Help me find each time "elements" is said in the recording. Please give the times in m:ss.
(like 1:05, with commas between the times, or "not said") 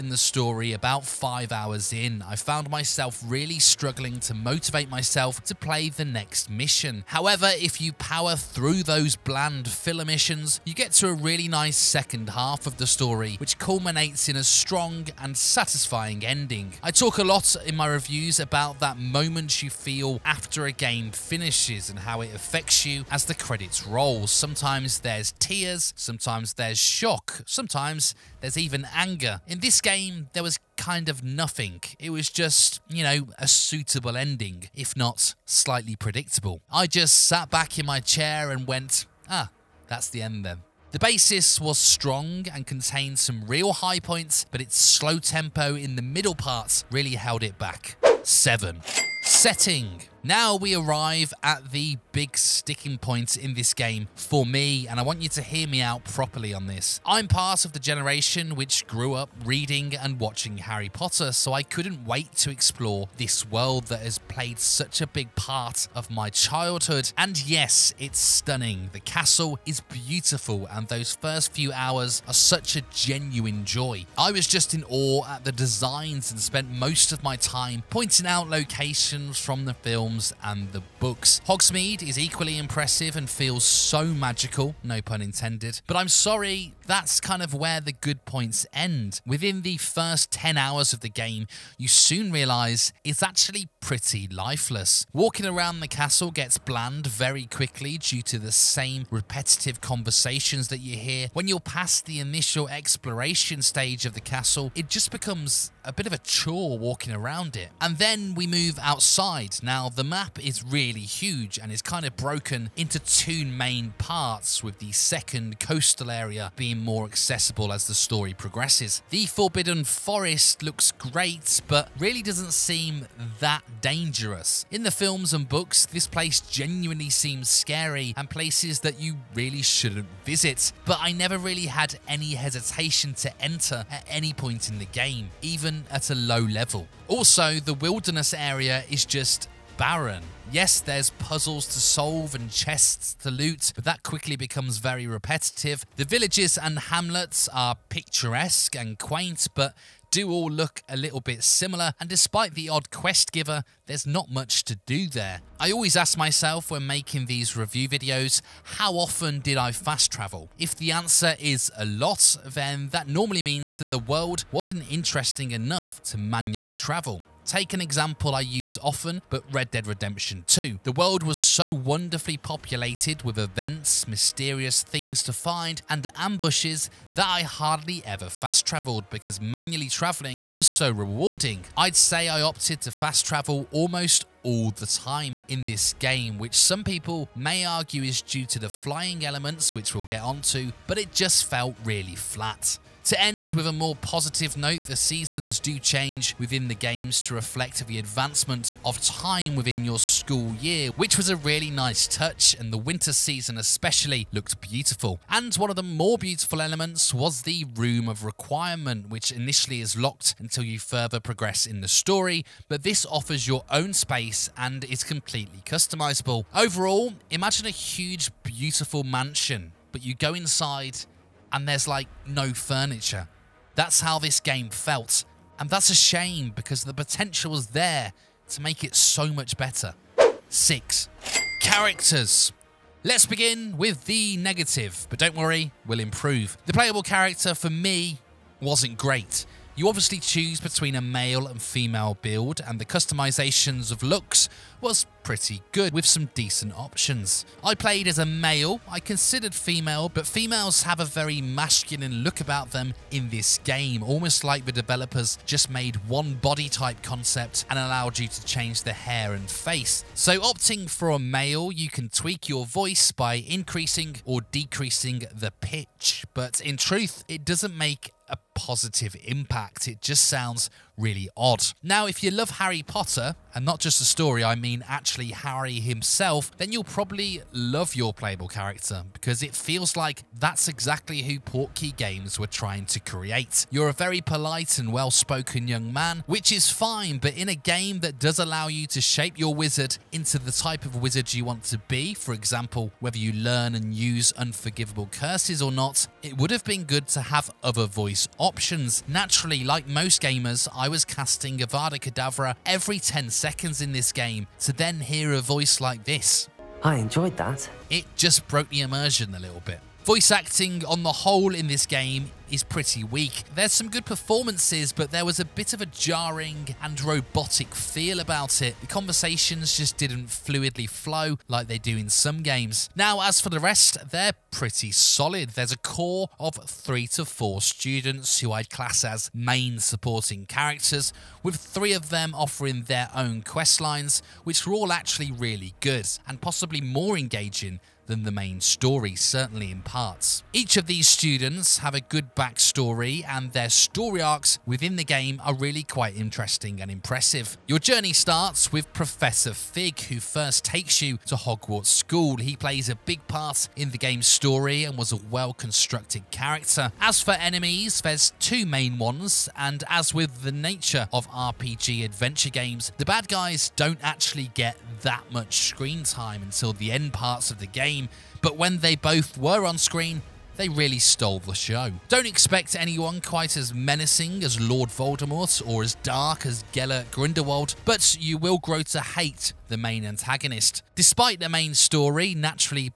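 3:09, 3:26.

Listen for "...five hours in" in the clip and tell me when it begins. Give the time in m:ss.
0:01.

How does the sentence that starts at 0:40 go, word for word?
The basis was strong and contained some real high points, but its slow tempo in the middle parts really held it back.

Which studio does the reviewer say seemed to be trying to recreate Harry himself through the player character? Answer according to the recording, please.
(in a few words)
Portkey Games.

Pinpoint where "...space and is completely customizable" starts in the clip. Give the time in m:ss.
3:33.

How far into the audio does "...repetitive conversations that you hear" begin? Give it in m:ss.
1:39.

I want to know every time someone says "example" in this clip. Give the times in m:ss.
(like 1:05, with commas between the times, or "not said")
2:47, 4:52.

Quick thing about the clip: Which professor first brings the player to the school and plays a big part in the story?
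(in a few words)
Professor Fig.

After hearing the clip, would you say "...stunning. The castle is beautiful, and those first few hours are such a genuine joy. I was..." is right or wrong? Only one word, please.
right.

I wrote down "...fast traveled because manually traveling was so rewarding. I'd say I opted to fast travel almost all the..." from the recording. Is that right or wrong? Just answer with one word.
right.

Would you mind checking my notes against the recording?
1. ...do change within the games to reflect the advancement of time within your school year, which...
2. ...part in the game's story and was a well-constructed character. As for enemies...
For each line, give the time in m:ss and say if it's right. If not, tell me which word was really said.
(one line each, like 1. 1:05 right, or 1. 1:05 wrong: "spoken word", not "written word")
1. 3:15 right
2. 5:53 right.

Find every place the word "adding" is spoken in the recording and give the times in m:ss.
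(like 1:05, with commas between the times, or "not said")
not said.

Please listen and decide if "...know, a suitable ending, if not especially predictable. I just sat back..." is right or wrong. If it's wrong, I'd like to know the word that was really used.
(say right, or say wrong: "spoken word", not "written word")
wrong: "slightly", not "especially".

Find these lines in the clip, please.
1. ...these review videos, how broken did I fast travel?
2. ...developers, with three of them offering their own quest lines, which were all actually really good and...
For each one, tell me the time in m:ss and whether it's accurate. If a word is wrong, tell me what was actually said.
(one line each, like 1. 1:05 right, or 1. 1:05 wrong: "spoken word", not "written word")
1. 2:37 wrong: "often", not "broken"
2. 5:30 wrong: "characters", not "developers".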